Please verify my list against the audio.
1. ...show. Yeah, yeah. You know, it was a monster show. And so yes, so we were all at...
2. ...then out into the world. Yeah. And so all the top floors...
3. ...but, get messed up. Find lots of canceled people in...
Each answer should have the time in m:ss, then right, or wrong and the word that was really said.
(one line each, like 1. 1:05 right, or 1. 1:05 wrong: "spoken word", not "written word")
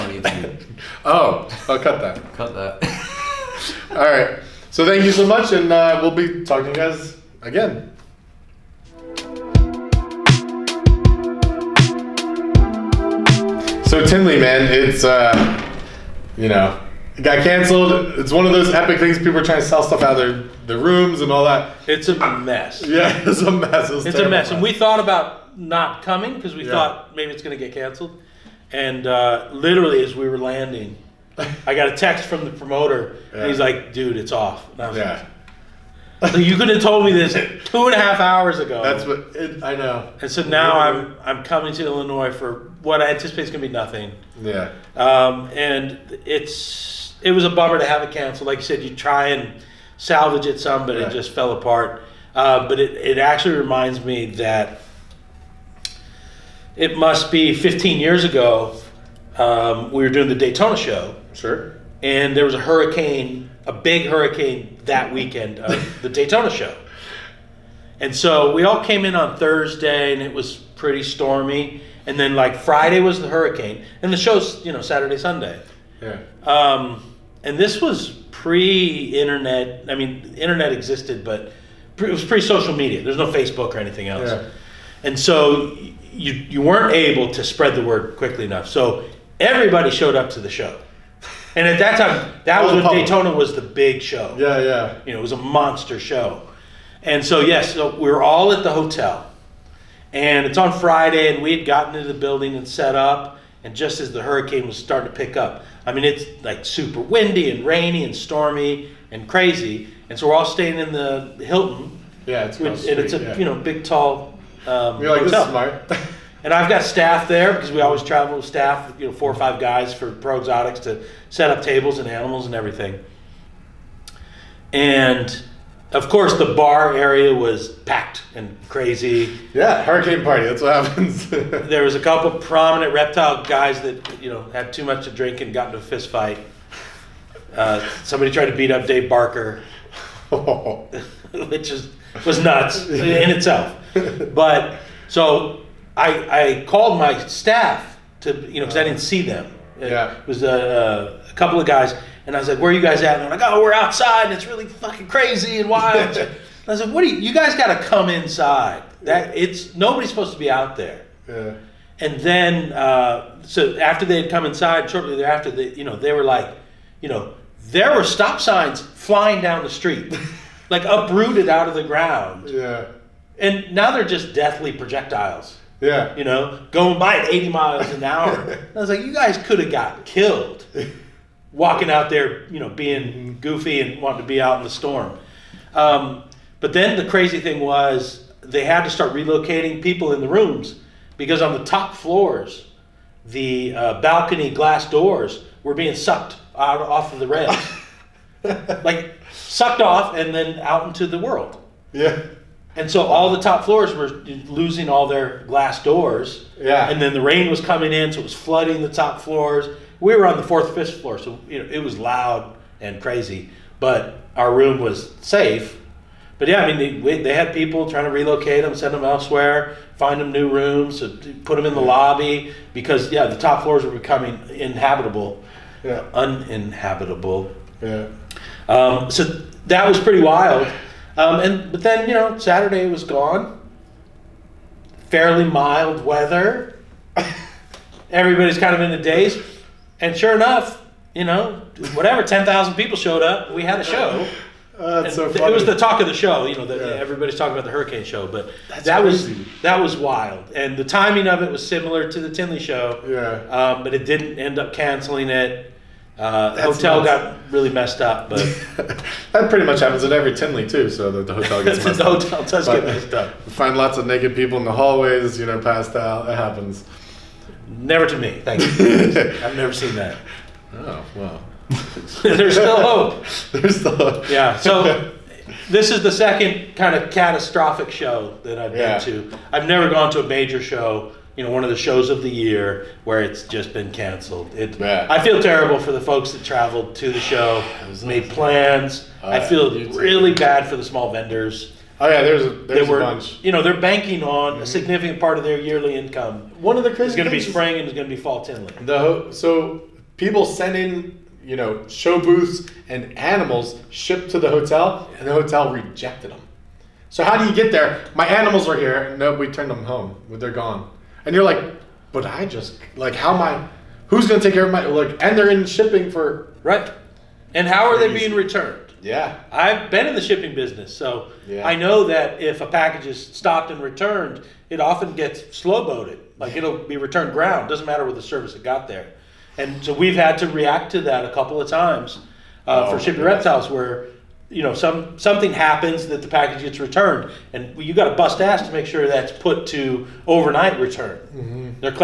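1. 1:34 right
2. 3:20 right
3. 4:22 wrong: "naked", not "canceled".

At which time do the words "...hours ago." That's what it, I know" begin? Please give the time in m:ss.
0:38.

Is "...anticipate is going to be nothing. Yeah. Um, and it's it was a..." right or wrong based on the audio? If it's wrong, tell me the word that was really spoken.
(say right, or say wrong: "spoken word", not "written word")
right.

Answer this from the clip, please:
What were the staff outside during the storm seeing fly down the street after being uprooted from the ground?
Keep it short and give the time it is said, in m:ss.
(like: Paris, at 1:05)
stop signs, at 2:48.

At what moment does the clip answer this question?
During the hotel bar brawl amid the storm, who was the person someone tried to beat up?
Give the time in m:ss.
2:18.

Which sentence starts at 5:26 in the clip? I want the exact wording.
Like it'll be returned ground, doesn't matter what the service it got there.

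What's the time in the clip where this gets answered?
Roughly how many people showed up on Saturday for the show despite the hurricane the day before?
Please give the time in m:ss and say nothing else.
4:02.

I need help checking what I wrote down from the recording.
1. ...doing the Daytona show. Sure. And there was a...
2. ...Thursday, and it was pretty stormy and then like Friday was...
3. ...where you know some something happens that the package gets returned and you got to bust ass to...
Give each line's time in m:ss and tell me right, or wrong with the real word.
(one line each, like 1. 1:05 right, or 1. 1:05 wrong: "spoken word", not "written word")
1. 1:00 right
2. 1:09 right
3. 5:33 right.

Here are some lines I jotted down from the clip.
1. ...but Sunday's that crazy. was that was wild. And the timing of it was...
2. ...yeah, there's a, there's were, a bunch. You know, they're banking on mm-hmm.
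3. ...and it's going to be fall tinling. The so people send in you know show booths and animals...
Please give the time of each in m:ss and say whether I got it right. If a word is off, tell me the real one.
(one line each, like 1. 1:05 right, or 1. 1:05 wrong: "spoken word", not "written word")
1. 4:08 wrong: "That", not "Sunday"
2. 4:52 right
3. 4:57 right.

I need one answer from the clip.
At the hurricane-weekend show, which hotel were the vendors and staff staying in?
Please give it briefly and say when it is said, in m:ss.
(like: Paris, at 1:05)
Hilton, at 1:51.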